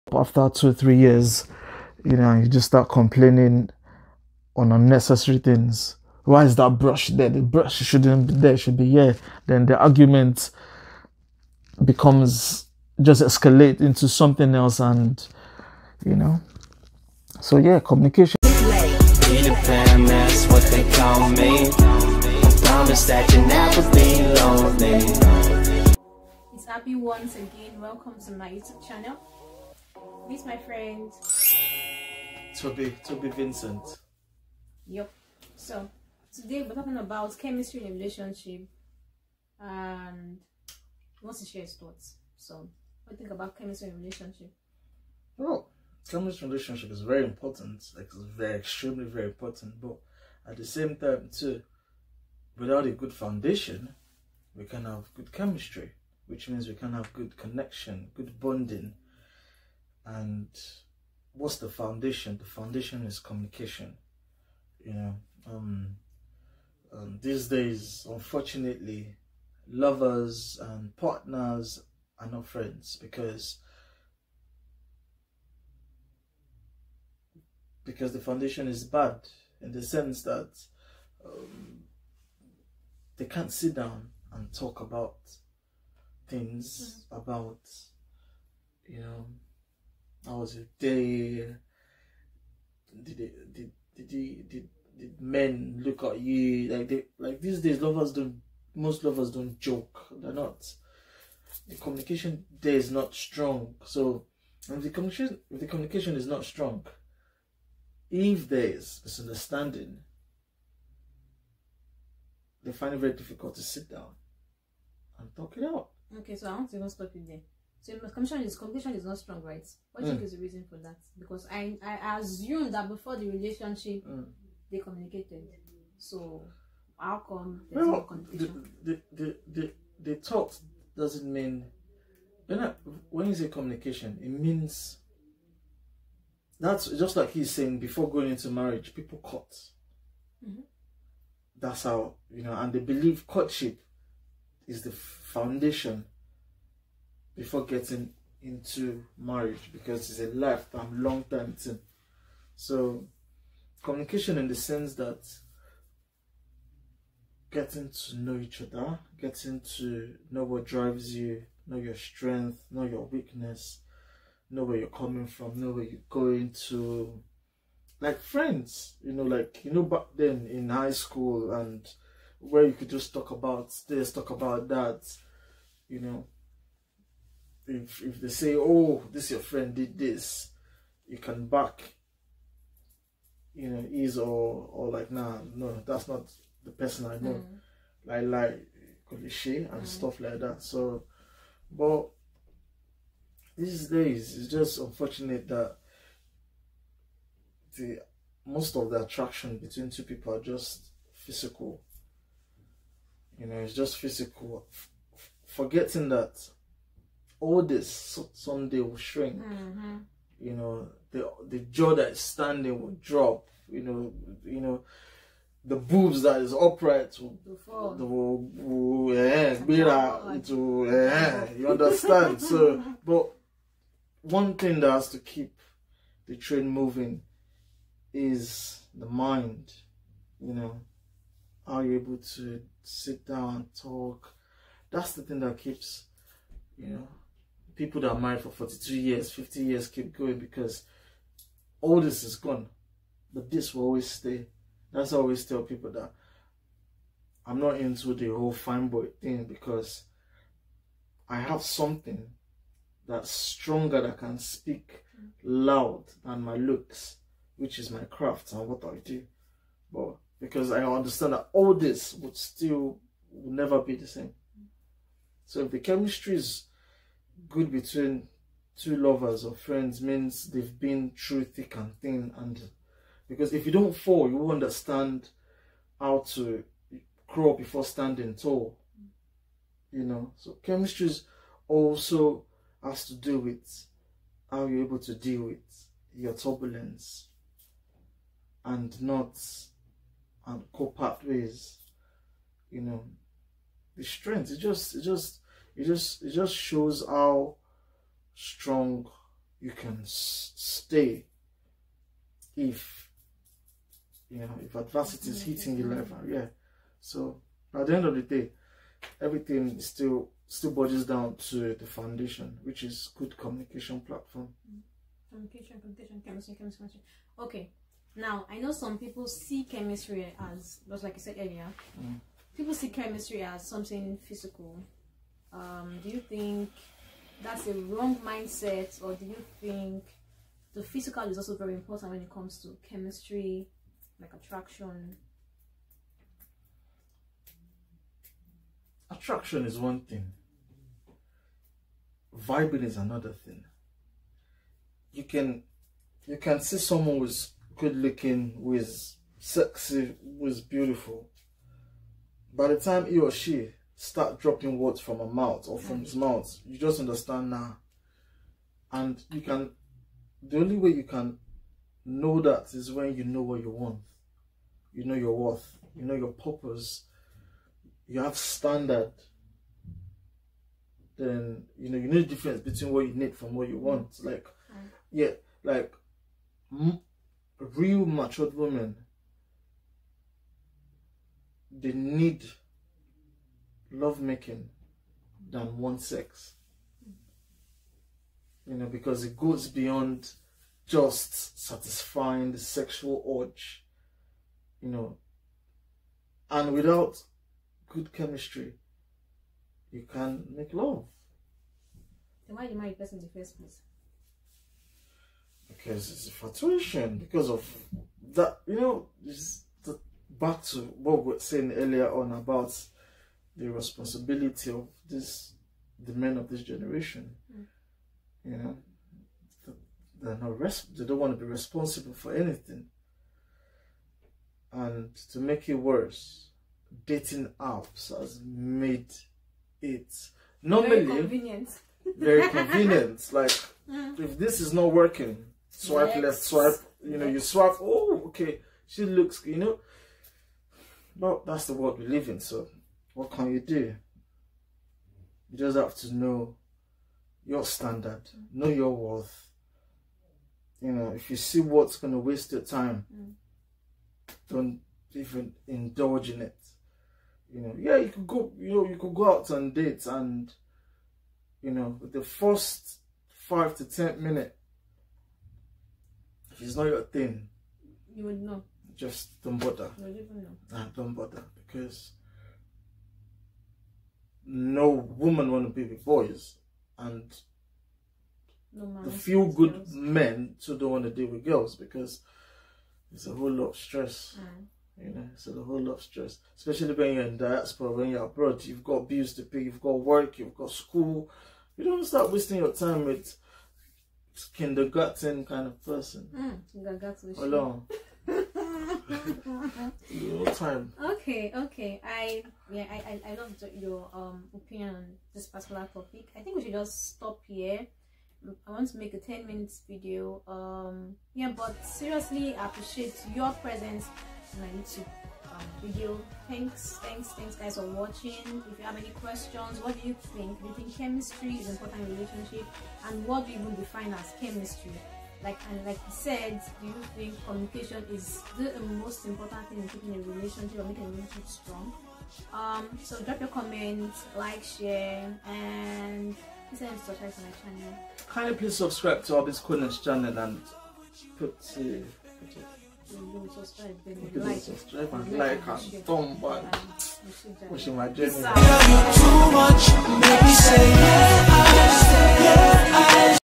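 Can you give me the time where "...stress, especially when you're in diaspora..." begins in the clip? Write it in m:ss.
8:06.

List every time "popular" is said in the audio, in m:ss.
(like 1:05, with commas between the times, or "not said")
not said.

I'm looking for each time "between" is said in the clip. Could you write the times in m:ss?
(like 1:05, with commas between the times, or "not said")
3:19, 4:27, 6:12.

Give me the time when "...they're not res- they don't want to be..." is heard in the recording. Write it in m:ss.
7:00.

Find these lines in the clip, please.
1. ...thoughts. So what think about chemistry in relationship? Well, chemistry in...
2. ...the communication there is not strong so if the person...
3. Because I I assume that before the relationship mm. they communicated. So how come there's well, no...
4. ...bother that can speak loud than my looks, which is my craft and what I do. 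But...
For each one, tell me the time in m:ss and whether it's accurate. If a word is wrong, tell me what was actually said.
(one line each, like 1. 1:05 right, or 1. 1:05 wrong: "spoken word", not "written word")
1. 0:41 right
2. 1:41 wrong: "communication", not "person"
3. 2:01 right
4. 4:13 wrong: "stronger", not "bother".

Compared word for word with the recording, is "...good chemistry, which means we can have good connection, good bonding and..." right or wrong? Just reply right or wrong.
right.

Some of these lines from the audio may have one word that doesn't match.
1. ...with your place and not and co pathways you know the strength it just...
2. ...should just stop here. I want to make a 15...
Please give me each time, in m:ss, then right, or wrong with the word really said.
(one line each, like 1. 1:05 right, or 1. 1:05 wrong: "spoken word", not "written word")
1. 4:45 wrong: "turbulence", not "place"
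2. 8:26 wrong: "10", not "15".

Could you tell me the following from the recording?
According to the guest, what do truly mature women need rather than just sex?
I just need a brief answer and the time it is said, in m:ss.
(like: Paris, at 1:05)
Lovemaking, at 6:23.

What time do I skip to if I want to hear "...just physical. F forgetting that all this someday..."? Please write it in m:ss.
3:23.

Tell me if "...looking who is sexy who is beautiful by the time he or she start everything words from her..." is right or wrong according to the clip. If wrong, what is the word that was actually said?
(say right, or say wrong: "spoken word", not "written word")
wrong: "dropping", not "everything".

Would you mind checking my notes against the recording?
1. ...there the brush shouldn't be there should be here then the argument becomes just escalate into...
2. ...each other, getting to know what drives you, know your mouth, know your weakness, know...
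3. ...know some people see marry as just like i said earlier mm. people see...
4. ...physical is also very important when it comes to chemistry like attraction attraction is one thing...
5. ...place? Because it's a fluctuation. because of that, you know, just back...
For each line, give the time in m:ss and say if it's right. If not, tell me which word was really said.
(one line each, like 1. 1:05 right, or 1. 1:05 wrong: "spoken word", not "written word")
1. 0:07 right
2. 2:38 wrong: "strength", not "mouth"
3. 5:18 wrong: "chemistry", not "marry"
4. 5:30 right
5. 6:43 right.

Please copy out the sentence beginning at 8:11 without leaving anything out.
You don't start wasting your time with kindergarten kind of person.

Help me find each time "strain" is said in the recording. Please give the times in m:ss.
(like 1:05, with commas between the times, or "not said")
not said.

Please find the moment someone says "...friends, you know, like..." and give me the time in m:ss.
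2:48.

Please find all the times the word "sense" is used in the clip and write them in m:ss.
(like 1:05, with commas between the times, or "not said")
1:19, 2:34.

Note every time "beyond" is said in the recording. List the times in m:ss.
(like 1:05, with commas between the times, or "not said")
6:29.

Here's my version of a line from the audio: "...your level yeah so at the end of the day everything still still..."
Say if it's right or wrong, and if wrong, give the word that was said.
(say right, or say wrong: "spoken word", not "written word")
right.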